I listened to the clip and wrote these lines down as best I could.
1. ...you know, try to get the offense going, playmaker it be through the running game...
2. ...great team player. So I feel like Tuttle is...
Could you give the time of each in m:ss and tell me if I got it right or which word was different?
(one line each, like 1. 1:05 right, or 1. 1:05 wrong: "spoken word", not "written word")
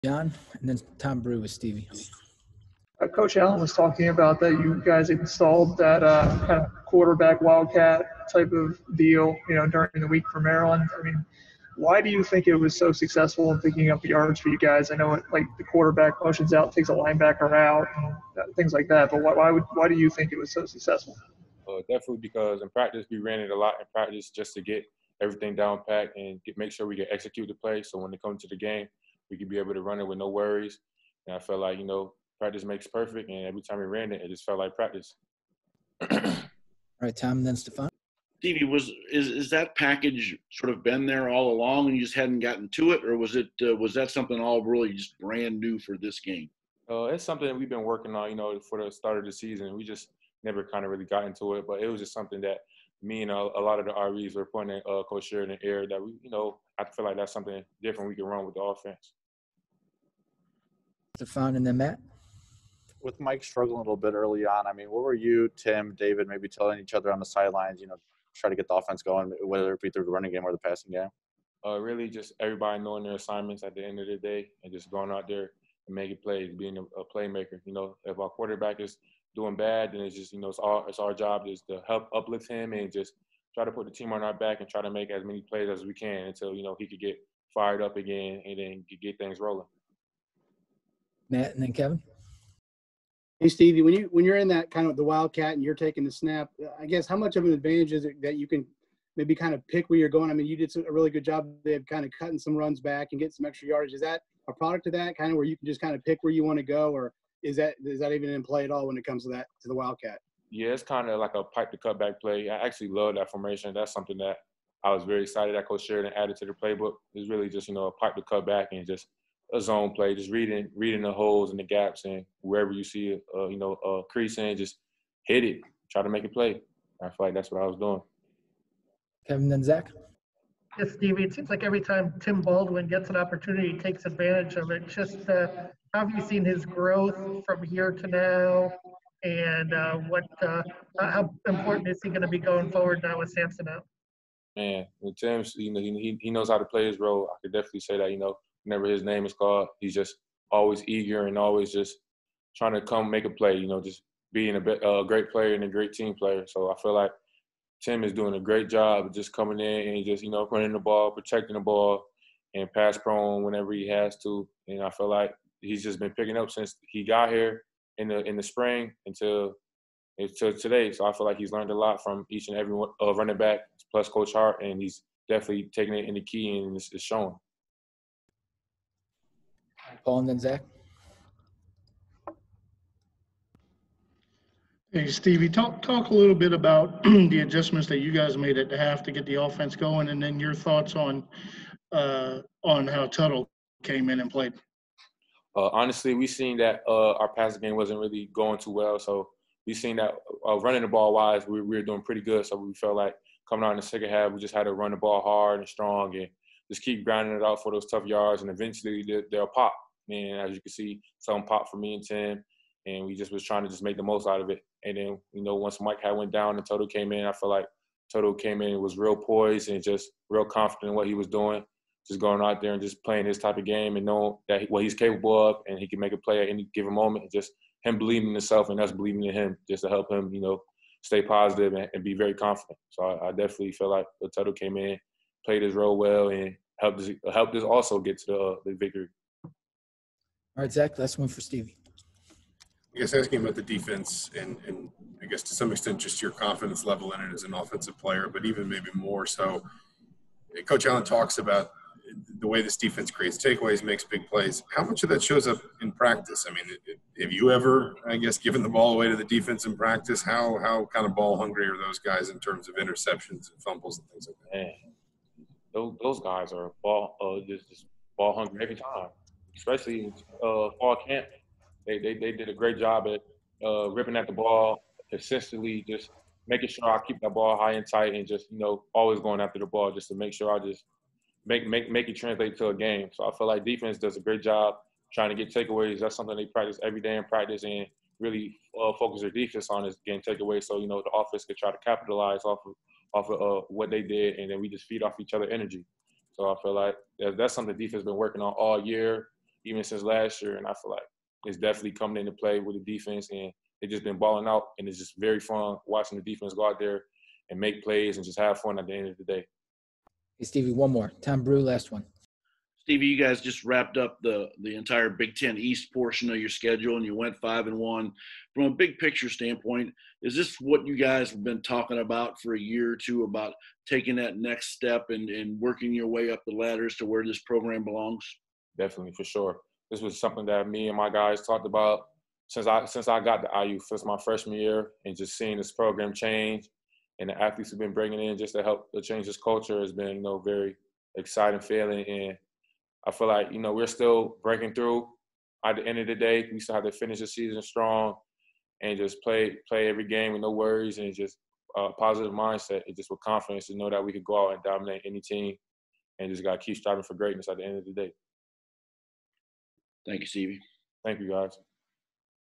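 1. 1:07 wrong: "whether", not "playmaker"
2. 2:35 wrong: "Tim", not "Tuttle".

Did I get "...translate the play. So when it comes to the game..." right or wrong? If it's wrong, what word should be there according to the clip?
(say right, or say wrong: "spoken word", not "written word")
wrong: "execute", not "translate".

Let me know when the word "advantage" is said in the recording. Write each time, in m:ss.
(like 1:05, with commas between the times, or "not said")
1:37, 2:14.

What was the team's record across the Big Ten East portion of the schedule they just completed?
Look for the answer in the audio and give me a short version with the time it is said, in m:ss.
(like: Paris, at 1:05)
5-1, at 5:17.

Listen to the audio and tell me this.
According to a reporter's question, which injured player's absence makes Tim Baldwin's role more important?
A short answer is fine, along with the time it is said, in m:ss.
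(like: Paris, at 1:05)
Sampson, at 2:23.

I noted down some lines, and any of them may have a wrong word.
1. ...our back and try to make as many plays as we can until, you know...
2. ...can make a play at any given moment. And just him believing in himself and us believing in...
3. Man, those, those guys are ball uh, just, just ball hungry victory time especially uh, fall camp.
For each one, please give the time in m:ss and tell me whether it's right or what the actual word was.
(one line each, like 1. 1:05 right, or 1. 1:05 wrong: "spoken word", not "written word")
1. 1:24 right
2. 3:45 right
3. 4:24 wrong: "every", not "victory".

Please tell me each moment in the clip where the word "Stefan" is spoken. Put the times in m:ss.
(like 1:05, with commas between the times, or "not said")
0:37, 1:01.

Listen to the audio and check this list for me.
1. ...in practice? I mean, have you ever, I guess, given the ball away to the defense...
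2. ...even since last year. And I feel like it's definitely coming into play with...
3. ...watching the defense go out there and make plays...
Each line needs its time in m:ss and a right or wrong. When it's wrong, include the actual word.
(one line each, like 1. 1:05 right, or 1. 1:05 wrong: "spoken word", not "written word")
1. 4:15 right
2. 4:59 right
3. 5:05 right.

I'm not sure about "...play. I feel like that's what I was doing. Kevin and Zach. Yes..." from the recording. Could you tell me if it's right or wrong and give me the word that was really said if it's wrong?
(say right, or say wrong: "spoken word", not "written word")
right.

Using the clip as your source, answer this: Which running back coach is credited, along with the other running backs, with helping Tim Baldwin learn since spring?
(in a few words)
Coach Hart.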